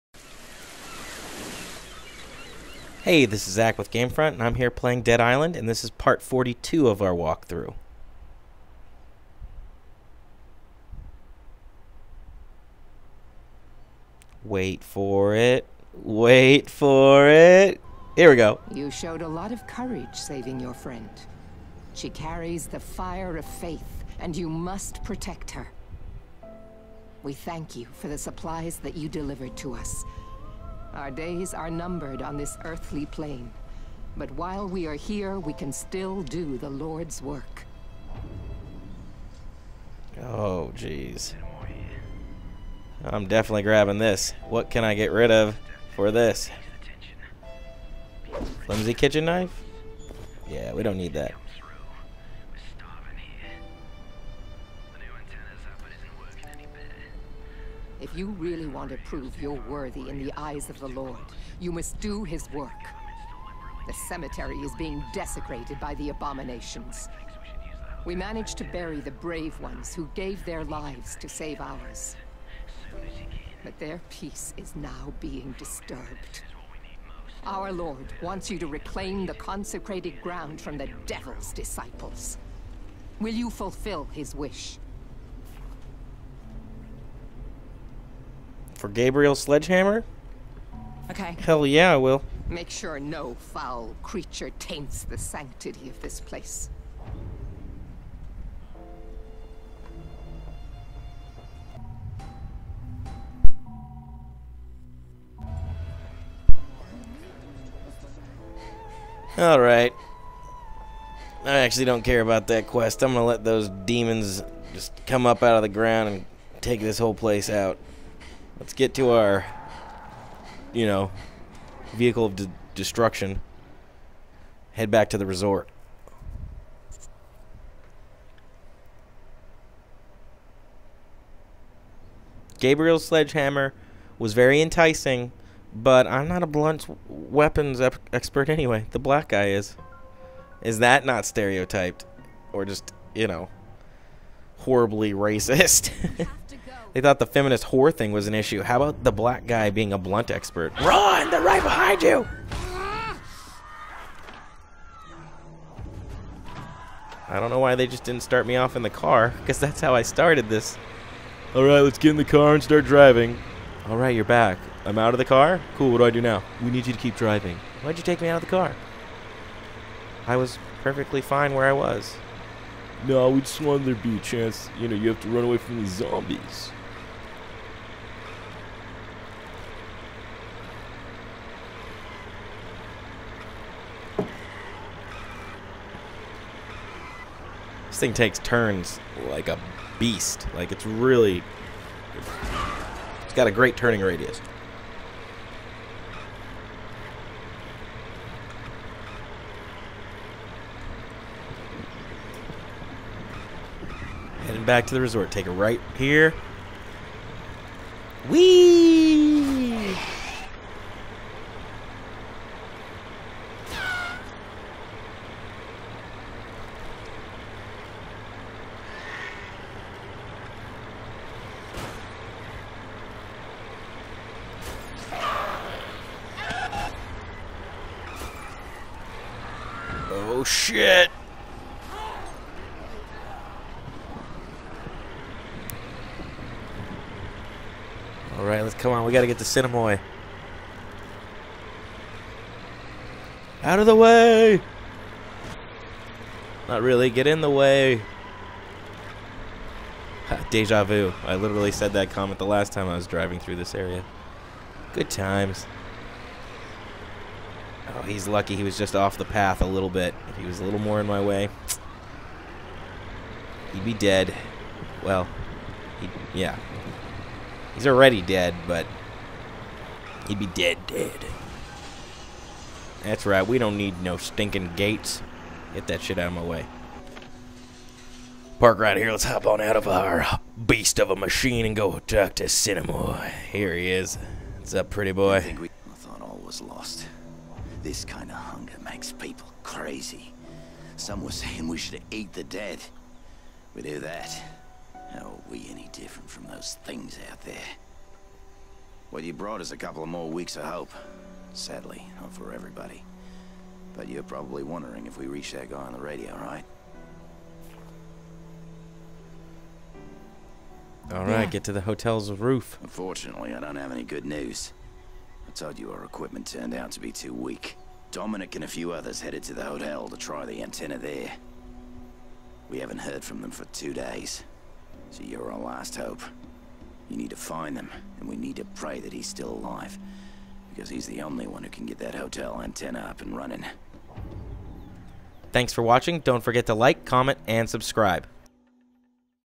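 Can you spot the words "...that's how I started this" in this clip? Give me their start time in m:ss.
2:39.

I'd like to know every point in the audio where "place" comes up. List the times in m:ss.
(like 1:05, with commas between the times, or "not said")
1:36, 1:57.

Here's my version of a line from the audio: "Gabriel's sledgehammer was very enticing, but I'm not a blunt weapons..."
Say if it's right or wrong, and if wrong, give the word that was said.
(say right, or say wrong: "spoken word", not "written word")
right.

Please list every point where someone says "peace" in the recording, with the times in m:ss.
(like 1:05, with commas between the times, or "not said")
1:14.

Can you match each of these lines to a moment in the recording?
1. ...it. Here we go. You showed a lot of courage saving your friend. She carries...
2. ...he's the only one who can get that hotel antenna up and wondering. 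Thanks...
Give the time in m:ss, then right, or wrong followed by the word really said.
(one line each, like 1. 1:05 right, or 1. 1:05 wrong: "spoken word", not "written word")
1. 0:17 right
2. 5:30 wrong: "running", not "wondering".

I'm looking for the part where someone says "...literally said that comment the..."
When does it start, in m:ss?
4:11.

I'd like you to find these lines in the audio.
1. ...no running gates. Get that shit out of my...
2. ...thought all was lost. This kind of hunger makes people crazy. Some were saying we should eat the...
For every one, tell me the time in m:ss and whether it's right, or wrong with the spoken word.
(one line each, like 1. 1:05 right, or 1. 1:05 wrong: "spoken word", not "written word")
1. 4:34 wrong: "stinking", not "running"
2. 4:45 right.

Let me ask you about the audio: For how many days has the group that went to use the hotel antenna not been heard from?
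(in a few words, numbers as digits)
2.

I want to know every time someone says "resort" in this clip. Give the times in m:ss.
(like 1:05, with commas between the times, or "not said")
2:05, 3:25.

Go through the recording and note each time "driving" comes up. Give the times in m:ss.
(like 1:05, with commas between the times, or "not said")
2:42, 2:47, 4:13.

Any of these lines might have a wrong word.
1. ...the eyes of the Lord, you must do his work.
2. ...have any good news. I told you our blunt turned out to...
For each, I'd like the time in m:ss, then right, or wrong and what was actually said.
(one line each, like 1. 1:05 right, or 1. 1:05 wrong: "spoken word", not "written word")
1. 1:00 right
2. 5:13 wrong: "equipment", not "blunt".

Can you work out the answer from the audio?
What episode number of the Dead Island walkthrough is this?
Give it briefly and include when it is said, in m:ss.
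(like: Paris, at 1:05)
42, at 0:05.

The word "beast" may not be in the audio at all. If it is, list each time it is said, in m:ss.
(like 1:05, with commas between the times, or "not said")
3:09, 4:40.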